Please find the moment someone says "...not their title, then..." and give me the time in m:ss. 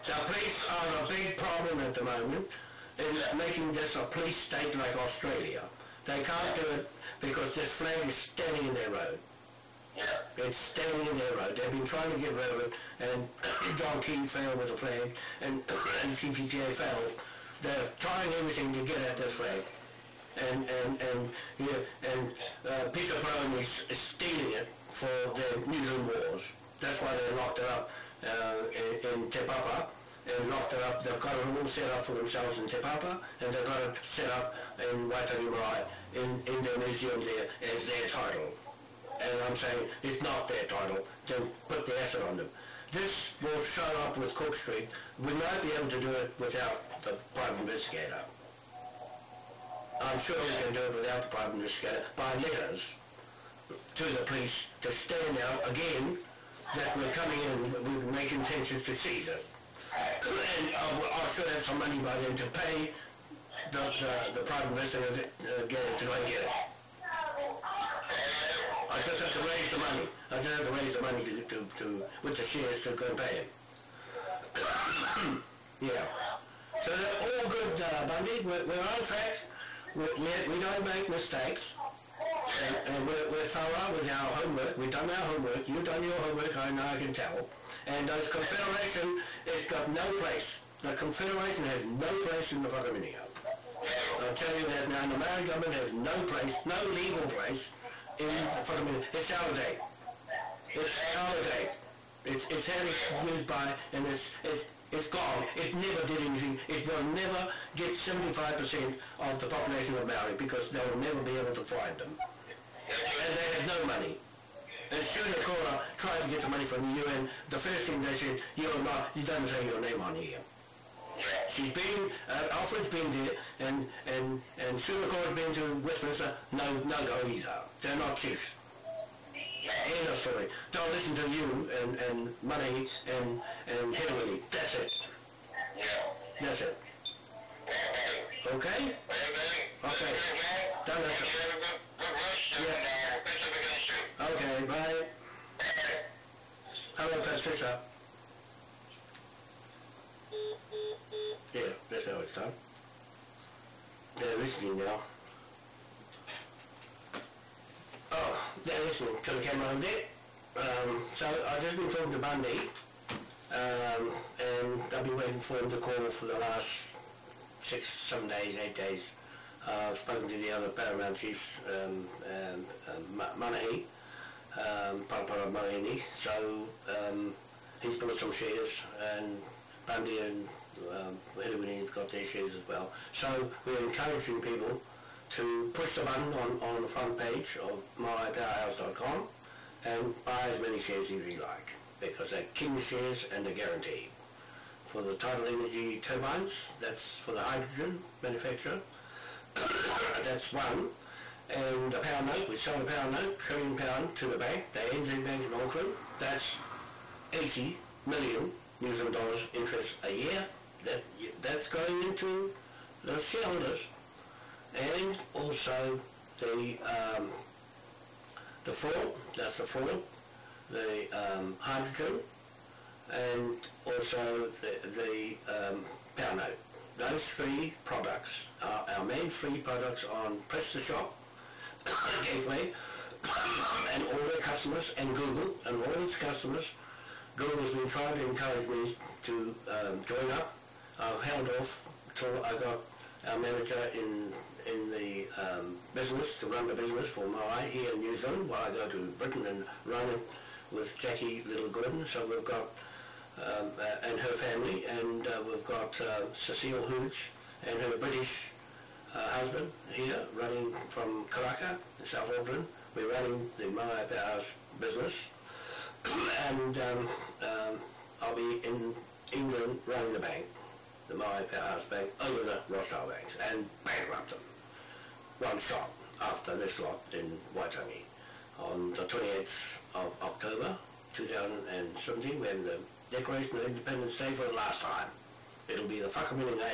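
0:40.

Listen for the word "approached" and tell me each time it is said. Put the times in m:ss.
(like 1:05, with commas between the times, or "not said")
not said.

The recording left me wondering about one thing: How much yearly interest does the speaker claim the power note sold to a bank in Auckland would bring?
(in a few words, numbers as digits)
NZ$80 million.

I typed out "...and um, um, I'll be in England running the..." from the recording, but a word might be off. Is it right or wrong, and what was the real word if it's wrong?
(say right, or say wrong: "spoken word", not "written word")
right.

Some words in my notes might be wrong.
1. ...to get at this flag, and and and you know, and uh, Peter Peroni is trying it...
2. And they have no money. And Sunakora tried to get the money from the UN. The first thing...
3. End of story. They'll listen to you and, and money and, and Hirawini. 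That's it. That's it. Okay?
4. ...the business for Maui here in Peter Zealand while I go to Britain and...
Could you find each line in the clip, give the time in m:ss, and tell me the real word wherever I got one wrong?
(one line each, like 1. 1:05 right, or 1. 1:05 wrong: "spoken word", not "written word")
1. 0:18 wrong: "stealing", not "trying"
2. 1:53 right
3. 2:09 right
4. 4:06 wrong: "New", not "Peter".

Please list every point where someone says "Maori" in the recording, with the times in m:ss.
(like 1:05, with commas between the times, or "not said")
1:35, 1:50.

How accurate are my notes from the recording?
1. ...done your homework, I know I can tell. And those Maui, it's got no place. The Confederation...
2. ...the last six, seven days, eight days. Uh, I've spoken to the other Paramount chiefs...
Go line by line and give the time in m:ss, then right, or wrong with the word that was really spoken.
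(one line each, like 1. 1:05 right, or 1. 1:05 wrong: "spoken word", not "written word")
1. 1:25 wrong: "Confederation", not "Maui"
2. 2:46 right.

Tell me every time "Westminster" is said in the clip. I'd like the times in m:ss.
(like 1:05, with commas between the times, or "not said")
2:05.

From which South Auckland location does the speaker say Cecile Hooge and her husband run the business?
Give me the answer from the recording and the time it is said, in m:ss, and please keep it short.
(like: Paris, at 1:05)
Karaka, at 4:21.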